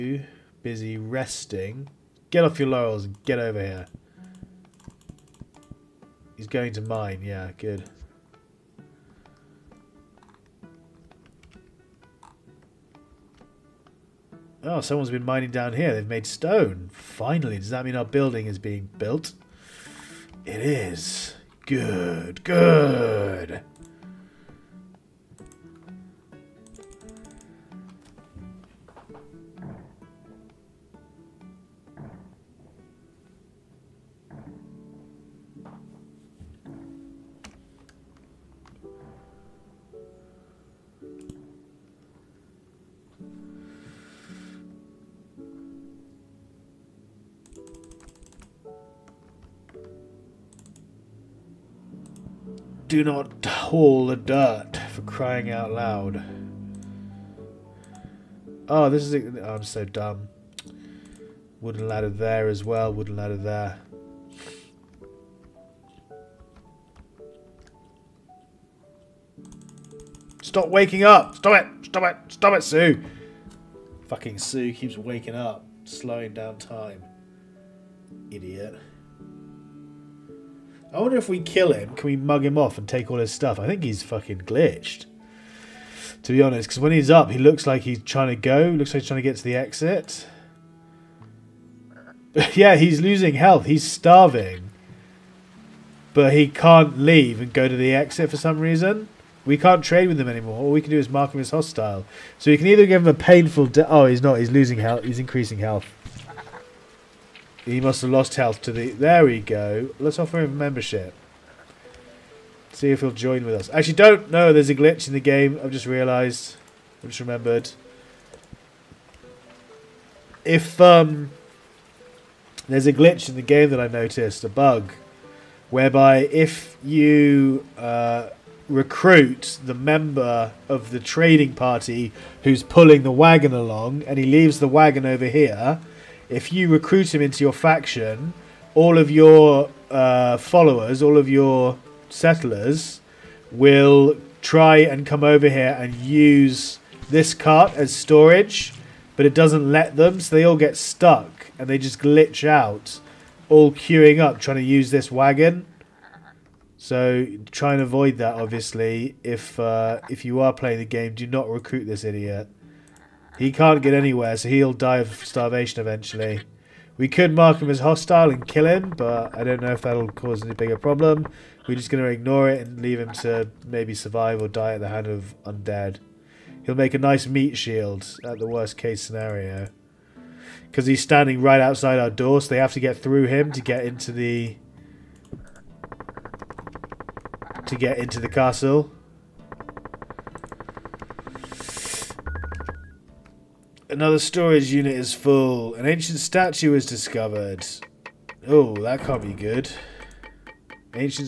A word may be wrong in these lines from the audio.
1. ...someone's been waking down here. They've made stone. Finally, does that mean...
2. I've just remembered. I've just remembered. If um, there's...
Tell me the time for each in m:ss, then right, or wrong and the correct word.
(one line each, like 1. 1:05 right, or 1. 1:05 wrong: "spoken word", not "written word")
1. 0:14 wrong: "mining", not "waking"
2. 1:55 wrong: "realised", not "remembered".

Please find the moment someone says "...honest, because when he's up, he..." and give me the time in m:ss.
1:26.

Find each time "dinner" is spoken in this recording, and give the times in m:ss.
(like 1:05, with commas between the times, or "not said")
not said.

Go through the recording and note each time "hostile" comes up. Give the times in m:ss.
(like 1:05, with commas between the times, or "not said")
1:41, 2:47.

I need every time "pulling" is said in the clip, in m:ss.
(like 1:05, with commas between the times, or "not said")
2:12.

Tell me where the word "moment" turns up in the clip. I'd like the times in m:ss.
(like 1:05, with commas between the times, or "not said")
not said.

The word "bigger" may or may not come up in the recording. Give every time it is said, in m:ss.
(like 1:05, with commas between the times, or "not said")
2:50.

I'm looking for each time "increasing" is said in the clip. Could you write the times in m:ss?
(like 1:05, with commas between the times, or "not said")
1:45.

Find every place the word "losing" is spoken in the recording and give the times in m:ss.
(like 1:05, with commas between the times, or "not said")
1:32, 1:44.